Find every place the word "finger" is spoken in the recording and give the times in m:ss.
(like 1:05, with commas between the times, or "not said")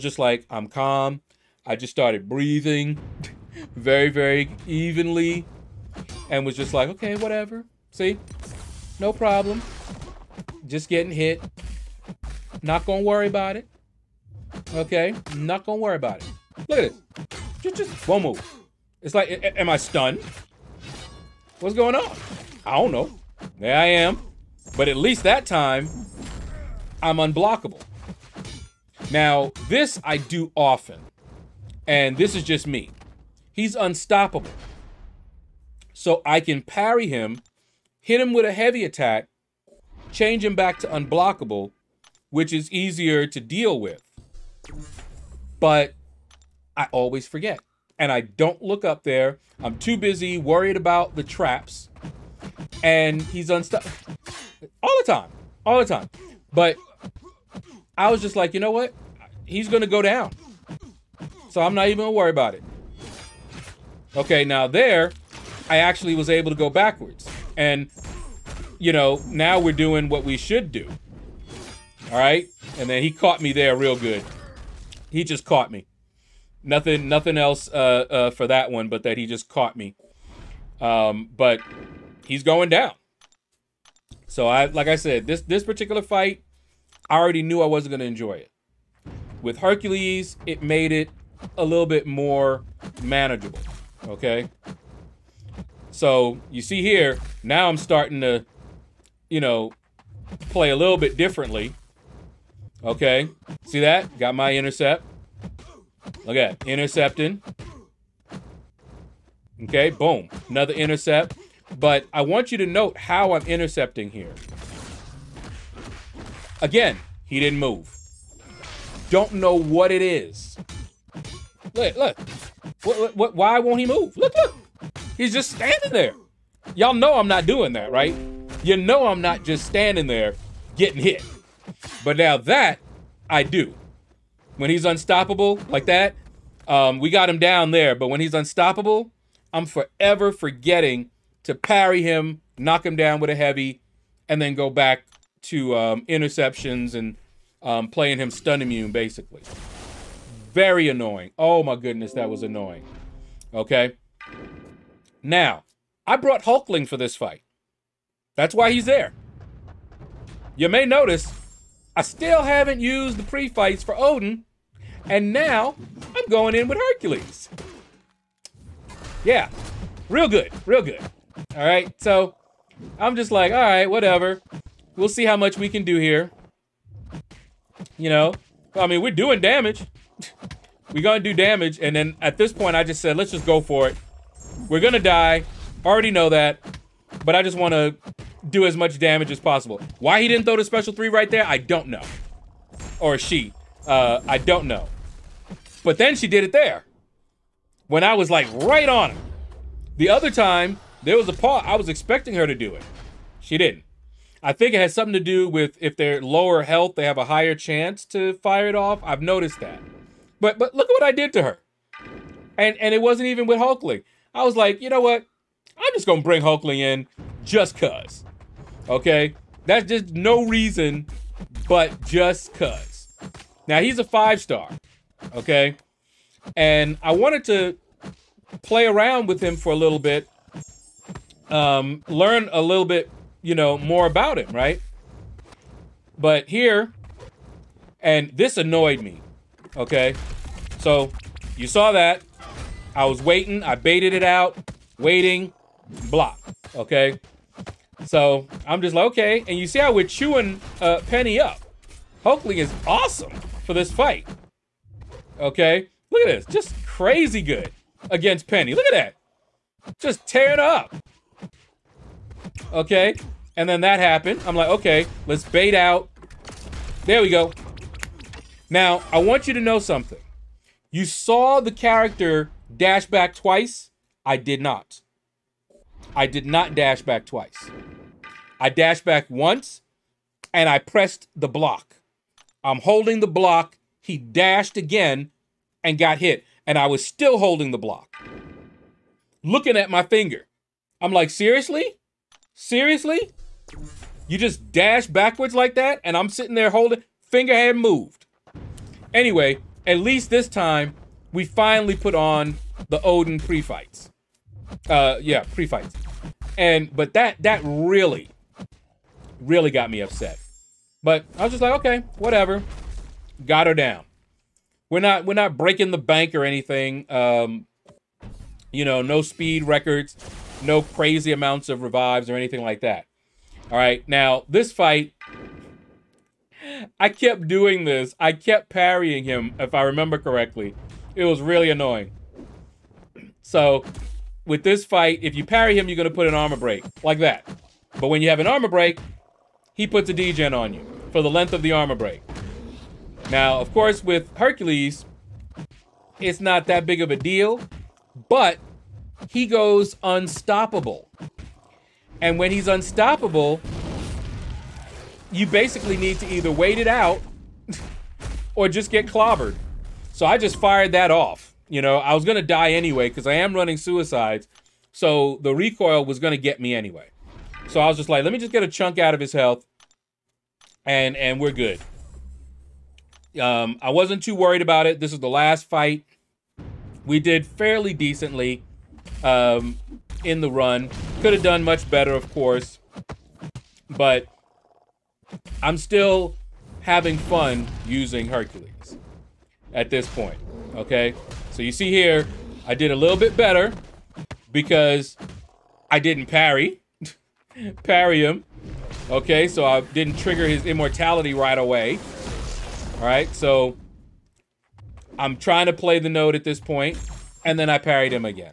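4:50, 4:57.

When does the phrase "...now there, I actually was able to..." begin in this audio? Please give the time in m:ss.
1:04.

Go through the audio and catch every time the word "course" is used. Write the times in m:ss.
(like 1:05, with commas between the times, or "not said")
5:43, 6:22.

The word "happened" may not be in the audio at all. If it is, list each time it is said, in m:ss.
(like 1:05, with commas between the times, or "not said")
4:23.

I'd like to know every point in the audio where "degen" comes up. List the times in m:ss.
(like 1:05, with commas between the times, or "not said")
5:40.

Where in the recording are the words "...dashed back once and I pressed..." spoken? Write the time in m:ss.
4:38.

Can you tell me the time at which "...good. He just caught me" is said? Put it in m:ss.
1:13.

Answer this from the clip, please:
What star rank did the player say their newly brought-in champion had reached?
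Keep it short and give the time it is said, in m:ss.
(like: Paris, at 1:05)
Five star, at 3:44.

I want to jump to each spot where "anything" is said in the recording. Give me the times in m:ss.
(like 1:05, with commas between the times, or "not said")
5:16, 5:22.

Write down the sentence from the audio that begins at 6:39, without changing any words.
So I didn't trigger his immortality right away, all right?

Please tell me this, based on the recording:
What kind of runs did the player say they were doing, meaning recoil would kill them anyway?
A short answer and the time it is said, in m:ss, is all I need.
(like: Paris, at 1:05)
Suicides, at 6:03.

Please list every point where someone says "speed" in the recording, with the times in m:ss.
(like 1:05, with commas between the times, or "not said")
5:19.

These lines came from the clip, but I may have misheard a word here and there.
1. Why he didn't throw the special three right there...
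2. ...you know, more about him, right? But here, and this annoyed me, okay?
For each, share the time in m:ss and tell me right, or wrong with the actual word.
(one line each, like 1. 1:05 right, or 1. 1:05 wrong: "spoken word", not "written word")
1. 3:10 right
2. 3:53 right.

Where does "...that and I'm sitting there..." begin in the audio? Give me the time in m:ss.
4:55.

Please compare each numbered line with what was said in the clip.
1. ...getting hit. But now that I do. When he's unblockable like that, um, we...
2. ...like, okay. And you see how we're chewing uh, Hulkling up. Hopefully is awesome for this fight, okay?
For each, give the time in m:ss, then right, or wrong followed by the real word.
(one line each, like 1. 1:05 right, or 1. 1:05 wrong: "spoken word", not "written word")
1. 2:10 wrong: "unstoppable", not "unblockable"
2. 4:08 wrong: "Penny", not "Hulkling".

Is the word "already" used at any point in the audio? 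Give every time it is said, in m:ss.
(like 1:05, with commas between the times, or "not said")
1:27, 3:05.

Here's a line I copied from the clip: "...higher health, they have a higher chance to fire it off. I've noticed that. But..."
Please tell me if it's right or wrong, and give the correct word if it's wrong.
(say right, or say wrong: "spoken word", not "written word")
wrong: "lower", not "higher".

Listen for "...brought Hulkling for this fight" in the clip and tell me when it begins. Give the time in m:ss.
2:36.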